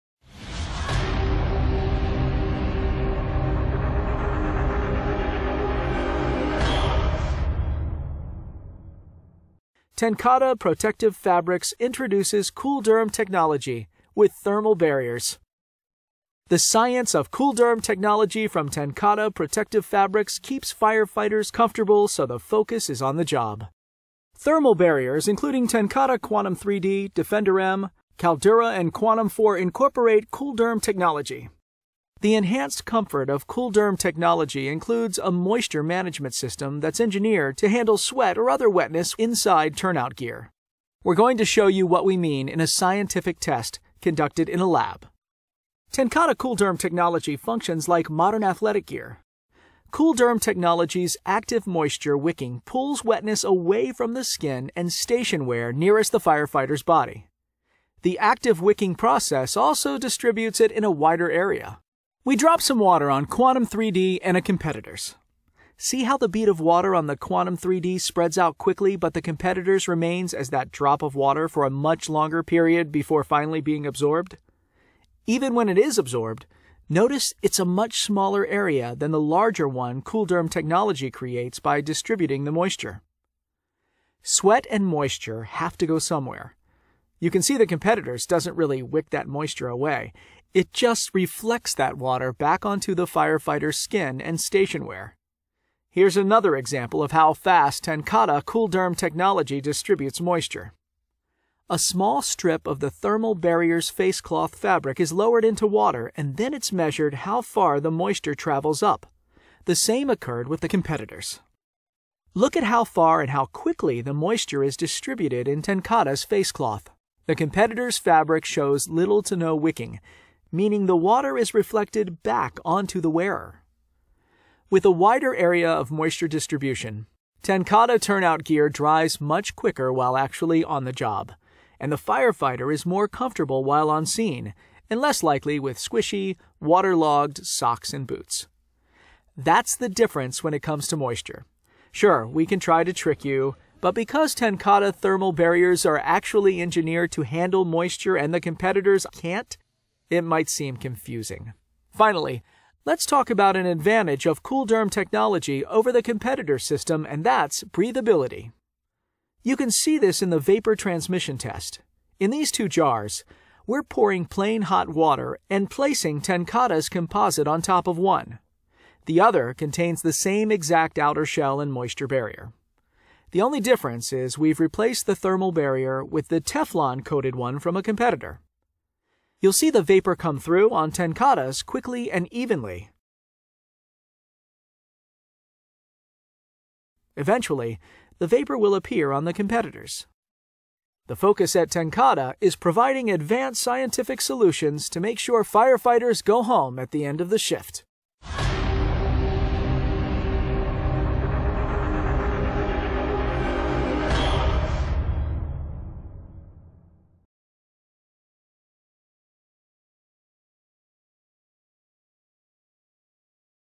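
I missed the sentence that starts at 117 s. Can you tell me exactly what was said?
The competitor's fabric shows little to no wicking, meaning the water is reflected back onto the wearer.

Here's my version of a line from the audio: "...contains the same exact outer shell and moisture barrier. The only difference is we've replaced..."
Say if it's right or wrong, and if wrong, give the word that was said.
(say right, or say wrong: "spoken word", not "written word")
right.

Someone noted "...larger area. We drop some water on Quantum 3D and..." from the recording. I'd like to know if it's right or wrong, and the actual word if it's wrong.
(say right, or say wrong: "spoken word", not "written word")
wrong: "wider", not "larger".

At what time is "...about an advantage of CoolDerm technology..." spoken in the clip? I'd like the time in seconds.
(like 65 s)
153 s.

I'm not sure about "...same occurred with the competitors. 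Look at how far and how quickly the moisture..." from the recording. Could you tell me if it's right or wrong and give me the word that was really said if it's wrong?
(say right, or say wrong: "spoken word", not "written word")
right.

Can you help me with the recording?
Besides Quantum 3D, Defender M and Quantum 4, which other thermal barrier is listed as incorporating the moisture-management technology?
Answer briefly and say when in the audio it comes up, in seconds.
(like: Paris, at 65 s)
Caldura, at 28 s.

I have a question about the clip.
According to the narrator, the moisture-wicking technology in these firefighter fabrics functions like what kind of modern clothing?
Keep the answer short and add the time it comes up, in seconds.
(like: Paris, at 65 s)
athletic gear, at 48 s.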